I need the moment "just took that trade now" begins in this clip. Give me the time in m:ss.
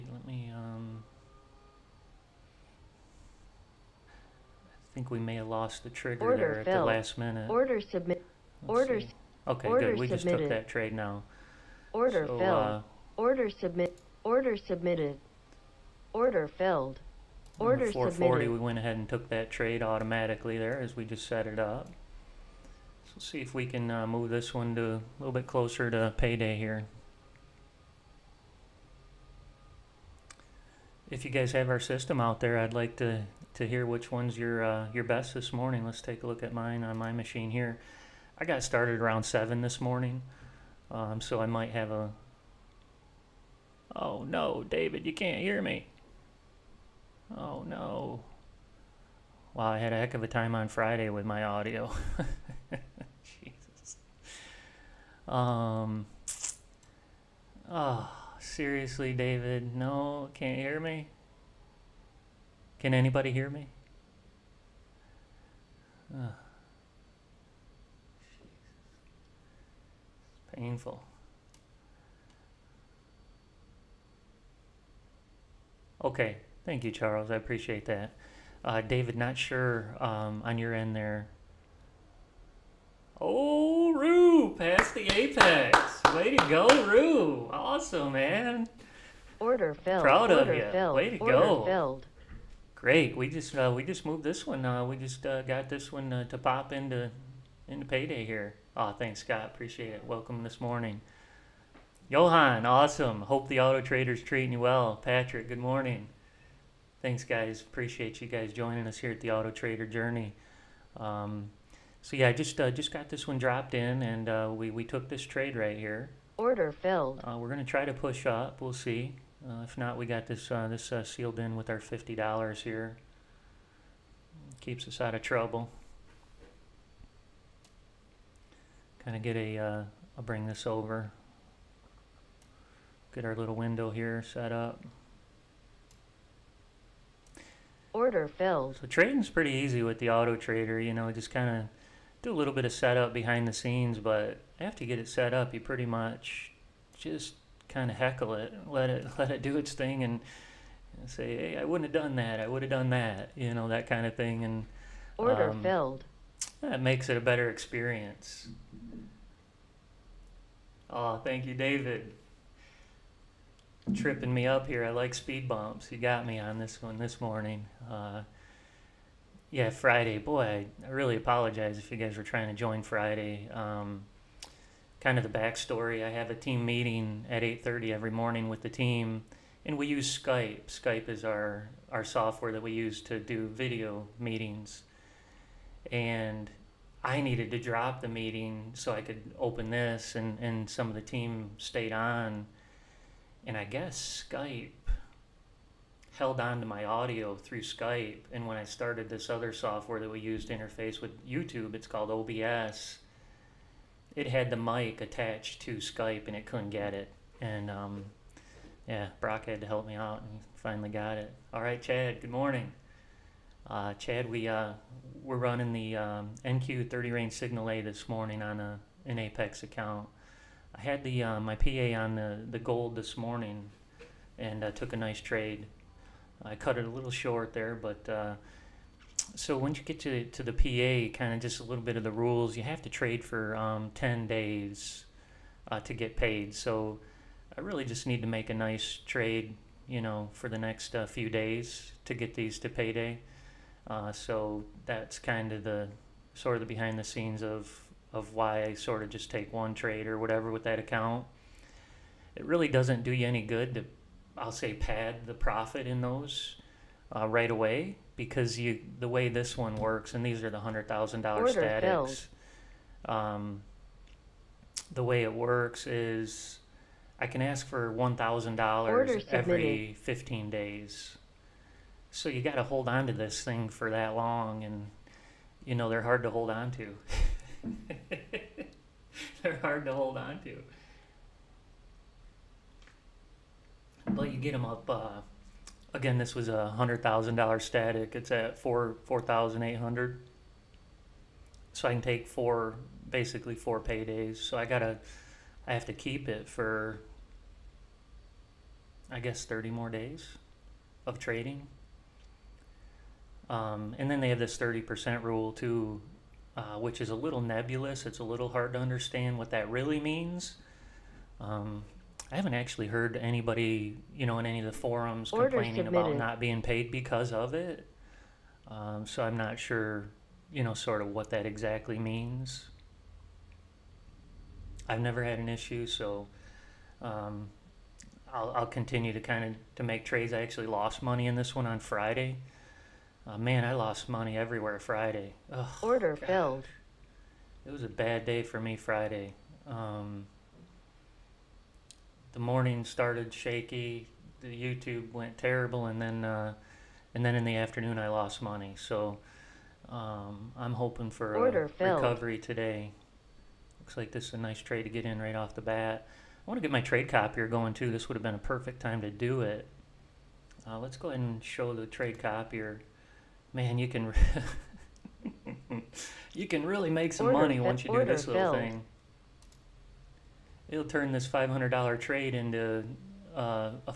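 0:10.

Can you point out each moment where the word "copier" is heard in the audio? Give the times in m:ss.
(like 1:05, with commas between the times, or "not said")
5:57, 6:02.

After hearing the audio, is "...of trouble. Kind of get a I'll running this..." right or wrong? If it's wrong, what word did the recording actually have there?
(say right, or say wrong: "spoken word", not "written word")
wrong: "bring", not "running".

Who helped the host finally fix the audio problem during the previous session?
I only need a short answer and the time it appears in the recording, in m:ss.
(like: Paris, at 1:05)
Brock, at 3:29.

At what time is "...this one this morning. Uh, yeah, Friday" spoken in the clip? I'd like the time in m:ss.
2:46.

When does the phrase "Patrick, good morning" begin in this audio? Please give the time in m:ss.
1:44.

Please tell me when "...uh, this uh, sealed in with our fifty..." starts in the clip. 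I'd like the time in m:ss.
2:00.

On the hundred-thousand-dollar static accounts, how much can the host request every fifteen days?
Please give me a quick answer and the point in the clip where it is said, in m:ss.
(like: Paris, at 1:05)
$1,000, at 4:27.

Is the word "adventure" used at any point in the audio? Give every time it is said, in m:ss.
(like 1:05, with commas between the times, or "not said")
not said.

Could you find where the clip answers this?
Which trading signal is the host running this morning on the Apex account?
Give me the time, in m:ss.
3:36.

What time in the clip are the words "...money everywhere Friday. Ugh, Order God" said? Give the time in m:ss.
5:34.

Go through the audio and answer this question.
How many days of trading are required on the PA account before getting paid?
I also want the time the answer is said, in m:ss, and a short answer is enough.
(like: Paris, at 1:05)
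10 days, at 3:53.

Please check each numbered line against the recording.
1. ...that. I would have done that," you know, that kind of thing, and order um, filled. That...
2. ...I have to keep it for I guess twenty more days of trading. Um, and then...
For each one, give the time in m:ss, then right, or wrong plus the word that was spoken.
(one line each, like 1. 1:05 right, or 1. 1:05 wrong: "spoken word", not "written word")
1. 2:32 right
2. 4:55 wrong: "thirty", not "twenty".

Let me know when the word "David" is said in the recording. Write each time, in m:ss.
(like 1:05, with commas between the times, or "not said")
0:44, 0:59, 1:18, 2:41.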